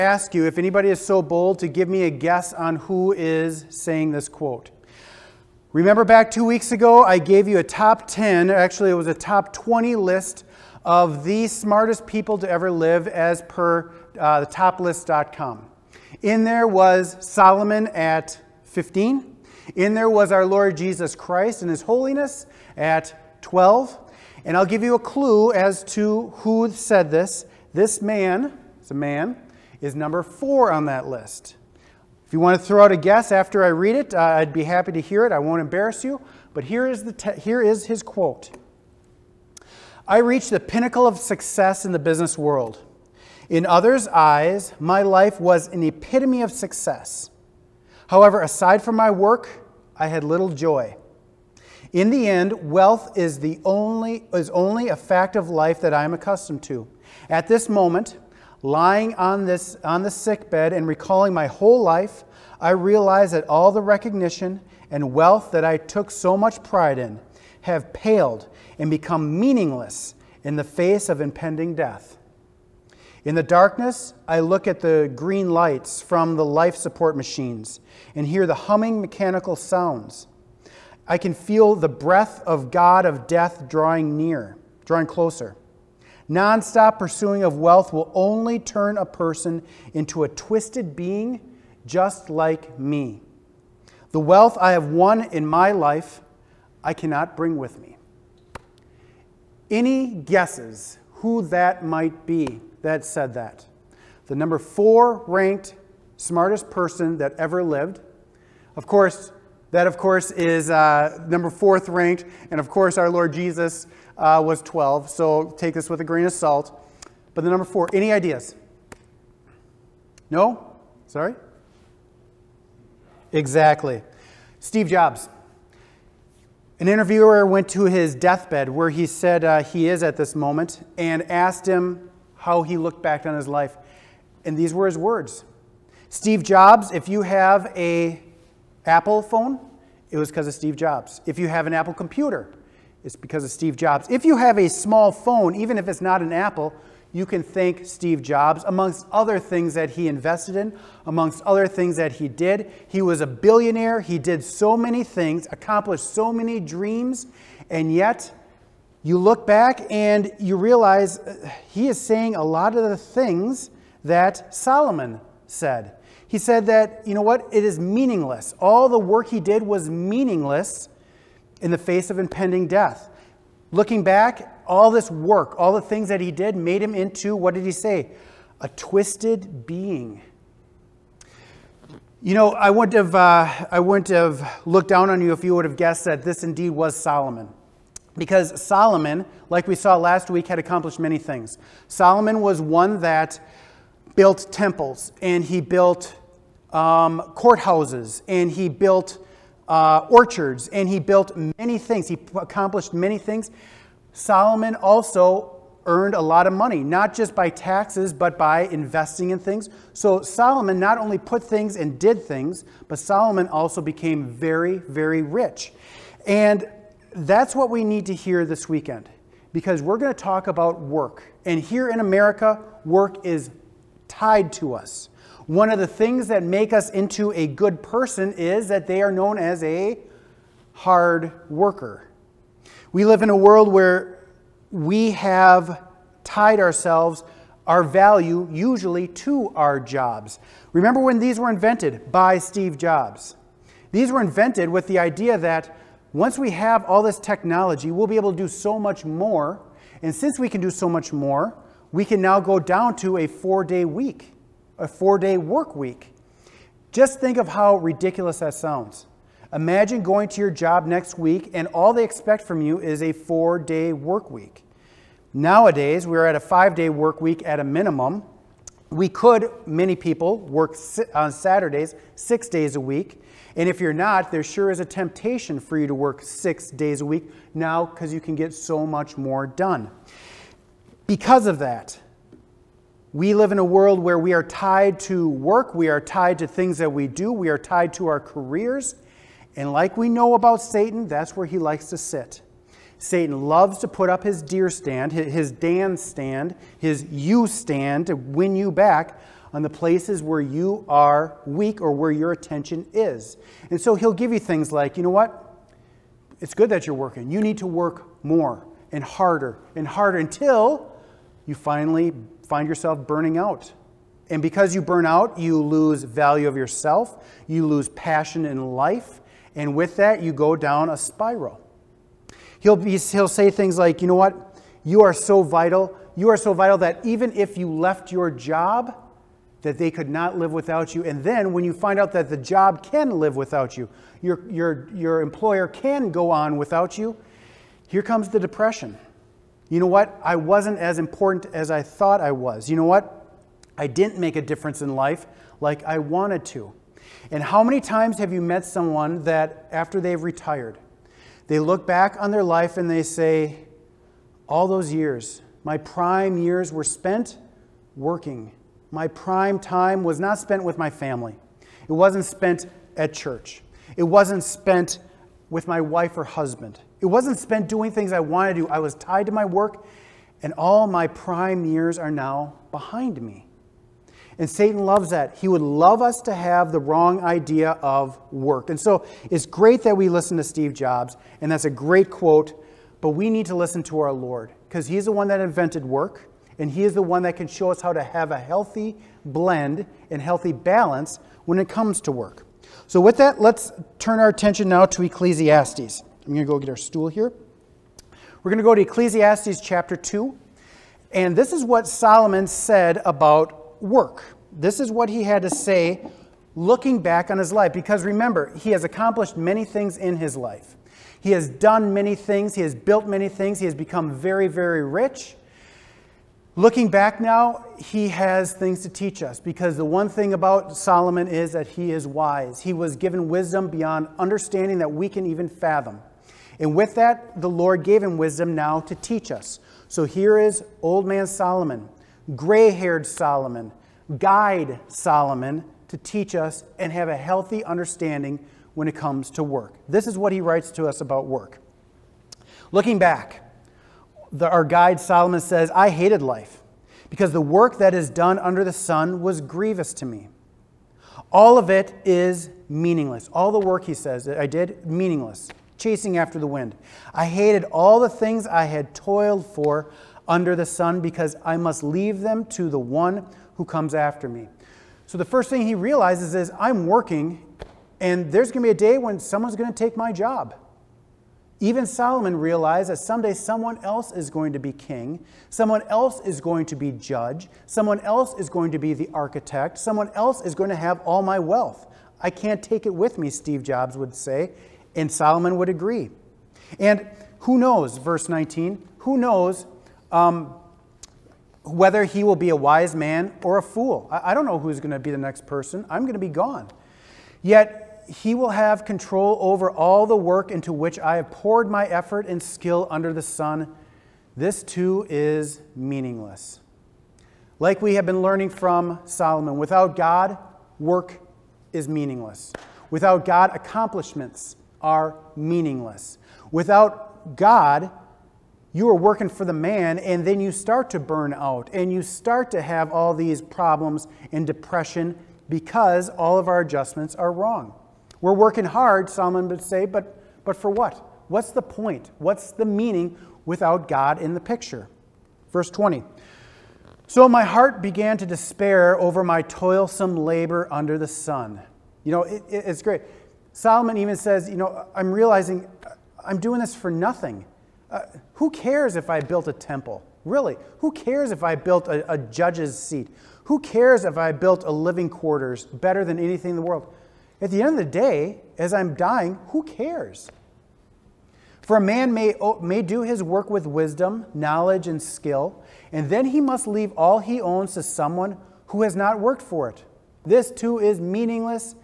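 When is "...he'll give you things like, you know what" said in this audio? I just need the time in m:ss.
5:03.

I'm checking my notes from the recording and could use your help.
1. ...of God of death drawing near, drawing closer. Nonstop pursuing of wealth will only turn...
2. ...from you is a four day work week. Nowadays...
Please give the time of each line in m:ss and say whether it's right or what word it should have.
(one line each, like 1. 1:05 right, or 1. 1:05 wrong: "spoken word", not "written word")
1. 1:22 right
2. 4:22 right.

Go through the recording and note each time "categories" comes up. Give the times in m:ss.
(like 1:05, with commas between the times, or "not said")
not said.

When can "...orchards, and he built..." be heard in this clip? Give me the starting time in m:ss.
3:20.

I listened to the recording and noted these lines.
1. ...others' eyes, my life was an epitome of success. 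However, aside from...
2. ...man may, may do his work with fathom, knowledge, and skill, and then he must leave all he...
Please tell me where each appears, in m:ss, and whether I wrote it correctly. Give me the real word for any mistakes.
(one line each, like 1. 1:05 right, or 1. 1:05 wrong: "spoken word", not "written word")
1. 0:43 right
2. 9:21 wrong: "wisdom", not "fathom".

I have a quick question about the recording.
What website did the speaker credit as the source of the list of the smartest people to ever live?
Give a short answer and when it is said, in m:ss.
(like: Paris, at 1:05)
thetoplist.com, at 0:14.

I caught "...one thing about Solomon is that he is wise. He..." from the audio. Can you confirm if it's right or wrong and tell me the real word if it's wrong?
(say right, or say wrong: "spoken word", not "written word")
right.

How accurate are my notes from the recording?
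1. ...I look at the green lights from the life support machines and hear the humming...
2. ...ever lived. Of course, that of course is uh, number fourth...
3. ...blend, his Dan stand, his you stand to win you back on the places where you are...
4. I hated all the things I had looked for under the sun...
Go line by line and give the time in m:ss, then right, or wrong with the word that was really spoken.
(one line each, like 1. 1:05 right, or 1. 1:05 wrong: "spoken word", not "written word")
1. 1:14 right
2. 1:47 right
3. 4:54 wrong: "stand", not "blend"
4. 7:37 wrong: "toiled", not "looked".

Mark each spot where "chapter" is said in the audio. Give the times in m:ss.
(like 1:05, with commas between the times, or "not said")
6:39.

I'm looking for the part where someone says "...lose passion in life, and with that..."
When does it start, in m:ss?
5:17.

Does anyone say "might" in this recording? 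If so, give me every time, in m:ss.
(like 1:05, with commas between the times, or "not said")
1:41.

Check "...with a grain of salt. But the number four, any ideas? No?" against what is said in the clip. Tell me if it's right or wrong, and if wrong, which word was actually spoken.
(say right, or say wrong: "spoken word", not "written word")
right.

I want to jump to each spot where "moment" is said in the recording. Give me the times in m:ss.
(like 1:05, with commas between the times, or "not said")
0:57, 2:10.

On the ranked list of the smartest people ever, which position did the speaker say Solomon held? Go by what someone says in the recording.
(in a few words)
15.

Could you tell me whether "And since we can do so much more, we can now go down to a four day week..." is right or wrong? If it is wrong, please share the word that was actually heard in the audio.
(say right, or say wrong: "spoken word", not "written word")
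right.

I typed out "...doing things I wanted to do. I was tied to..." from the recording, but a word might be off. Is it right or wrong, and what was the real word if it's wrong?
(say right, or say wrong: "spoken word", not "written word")
right.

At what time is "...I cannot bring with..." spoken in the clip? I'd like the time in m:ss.
1:36.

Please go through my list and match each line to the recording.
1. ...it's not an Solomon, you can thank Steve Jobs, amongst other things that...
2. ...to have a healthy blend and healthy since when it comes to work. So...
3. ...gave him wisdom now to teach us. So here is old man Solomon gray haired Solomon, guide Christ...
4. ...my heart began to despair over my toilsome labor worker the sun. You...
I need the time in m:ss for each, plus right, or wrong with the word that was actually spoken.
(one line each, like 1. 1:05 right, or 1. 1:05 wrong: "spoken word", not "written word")
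1. 2:25 wrong: "Apple", not "Solomon"
2. 6:27 wrong: "balance", not "since"
3. 7:07 wrong: "Solomon", not "Christ"
4. 8:57 wrong: "under", not "worker".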